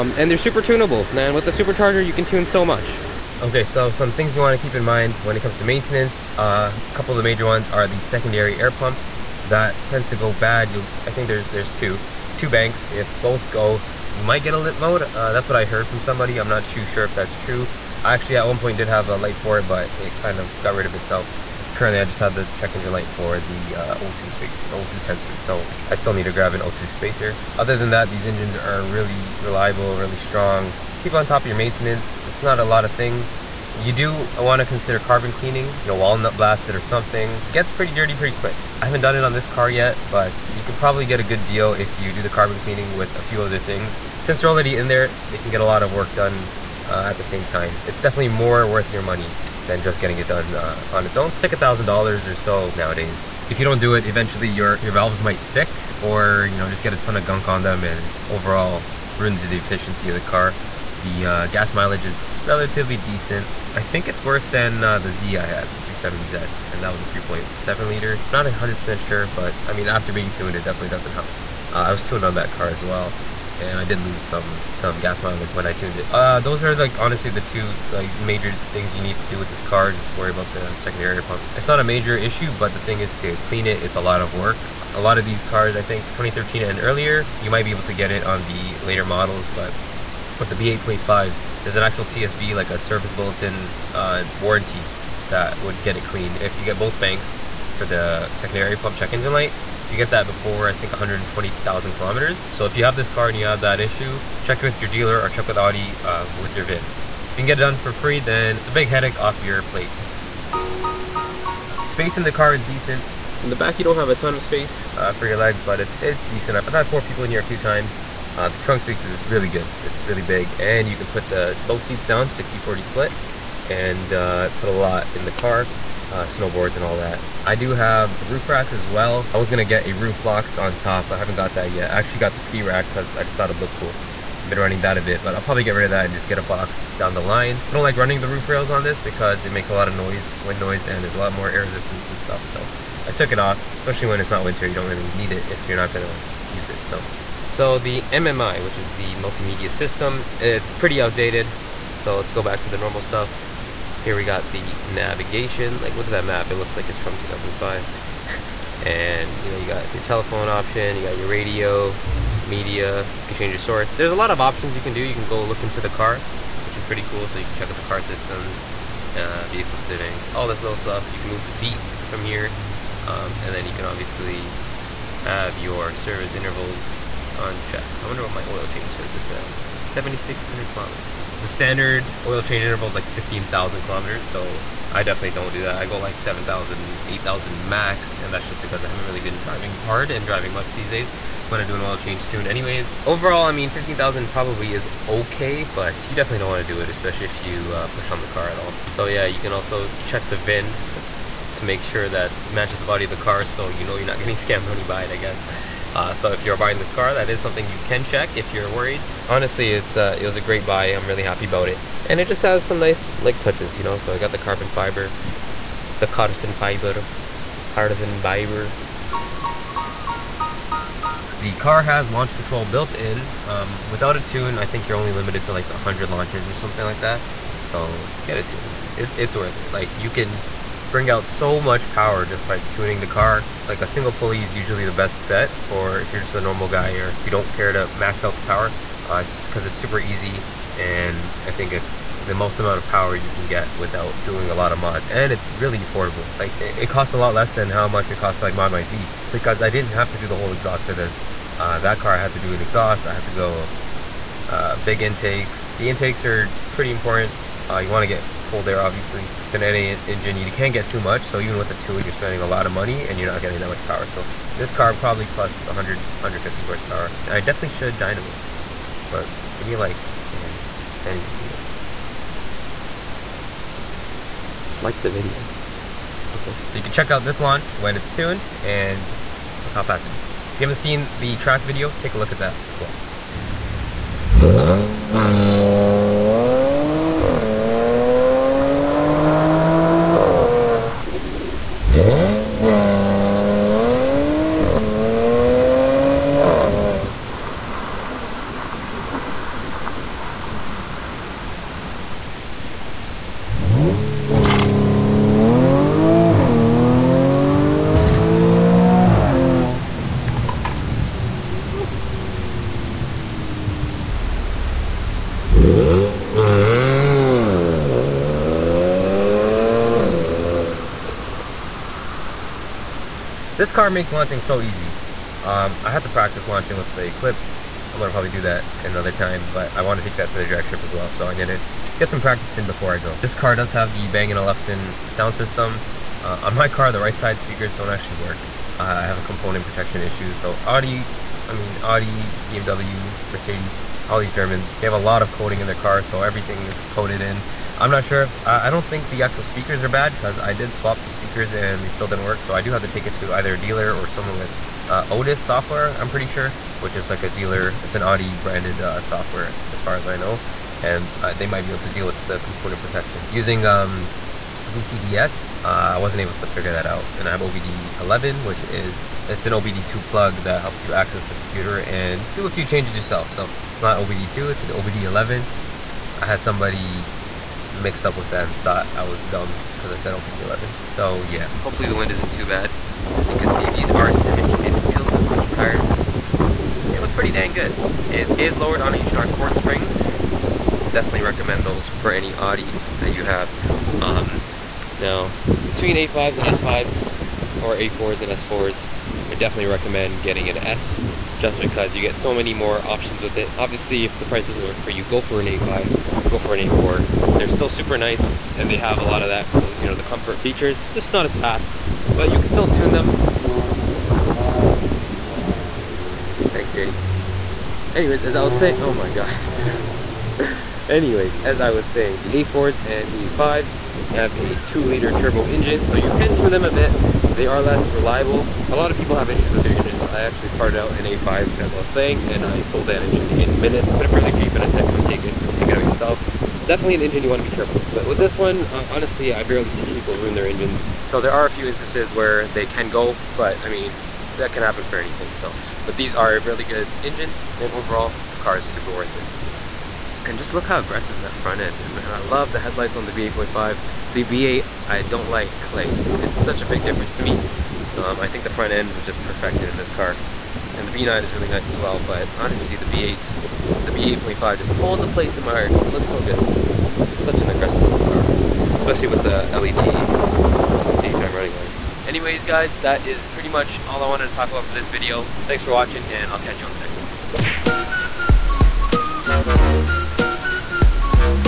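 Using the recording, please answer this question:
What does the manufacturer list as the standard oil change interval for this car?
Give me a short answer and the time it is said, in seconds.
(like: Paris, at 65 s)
15,000 km, at 183 s.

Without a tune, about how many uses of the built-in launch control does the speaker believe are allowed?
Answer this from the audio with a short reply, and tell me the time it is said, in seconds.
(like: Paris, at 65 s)
100, at 225 s.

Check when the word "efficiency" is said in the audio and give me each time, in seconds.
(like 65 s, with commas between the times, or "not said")
59 s.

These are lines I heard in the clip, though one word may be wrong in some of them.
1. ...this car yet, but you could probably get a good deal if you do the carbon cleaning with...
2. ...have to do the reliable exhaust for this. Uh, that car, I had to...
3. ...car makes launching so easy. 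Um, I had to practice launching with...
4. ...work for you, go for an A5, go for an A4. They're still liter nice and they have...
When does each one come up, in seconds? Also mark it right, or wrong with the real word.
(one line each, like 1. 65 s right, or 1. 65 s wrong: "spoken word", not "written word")
1. 39 s right
2. 249 s wrong: "whole", not "reliable"
3. 323 s right
4. 404 s wrong: "super", not "liter".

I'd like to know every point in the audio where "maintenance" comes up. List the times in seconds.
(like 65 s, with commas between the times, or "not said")
5 s, 31 s.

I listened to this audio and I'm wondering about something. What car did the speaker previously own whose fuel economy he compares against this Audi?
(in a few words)
370Z.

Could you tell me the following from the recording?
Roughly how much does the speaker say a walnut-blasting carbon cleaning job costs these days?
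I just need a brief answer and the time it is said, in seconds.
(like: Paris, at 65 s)
$1,000, at 51 s.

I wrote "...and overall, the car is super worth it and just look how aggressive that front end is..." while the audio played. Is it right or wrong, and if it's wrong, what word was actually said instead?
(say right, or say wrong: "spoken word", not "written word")
right.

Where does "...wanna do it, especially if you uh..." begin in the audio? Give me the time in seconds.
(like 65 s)
196 s.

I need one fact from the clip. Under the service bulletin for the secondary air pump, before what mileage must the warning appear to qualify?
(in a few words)
120,000 km.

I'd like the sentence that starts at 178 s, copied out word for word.
I wonder what my oil change says it's at.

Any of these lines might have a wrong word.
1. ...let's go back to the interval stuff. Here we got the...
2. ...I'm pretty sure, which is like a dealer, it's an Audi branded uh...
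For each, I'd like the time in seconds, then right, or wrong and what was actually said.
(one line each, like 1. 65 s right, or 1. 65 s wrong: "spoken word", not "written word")
1. 152 s wrong: "normal", not "interval"
2. 356 s right.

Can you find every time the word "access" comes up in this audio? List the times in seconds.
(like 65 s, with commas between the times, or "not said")
370 s.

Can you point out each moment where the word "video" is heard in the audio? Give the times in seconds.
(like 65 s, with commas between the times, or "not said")
275 s, 281 s, 474 s.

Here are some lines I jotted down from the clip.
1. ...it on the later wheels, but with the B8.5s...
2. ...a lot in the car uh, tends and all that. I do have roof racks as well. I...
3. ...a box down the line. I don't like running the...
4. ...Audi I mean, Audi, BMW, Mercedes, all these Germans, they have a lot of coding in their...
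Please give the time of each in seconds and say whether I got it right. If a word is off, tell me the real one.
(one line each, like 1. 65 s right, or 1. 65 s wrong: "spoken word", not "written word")
1. 88 s wrong: "models", not "wheels"
2. 124 s wrong: "snowboards", not "tends"
3. 136 s right
4. 340 s right.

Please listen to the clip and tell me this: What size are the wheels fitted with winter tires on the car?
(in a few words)
17 inch.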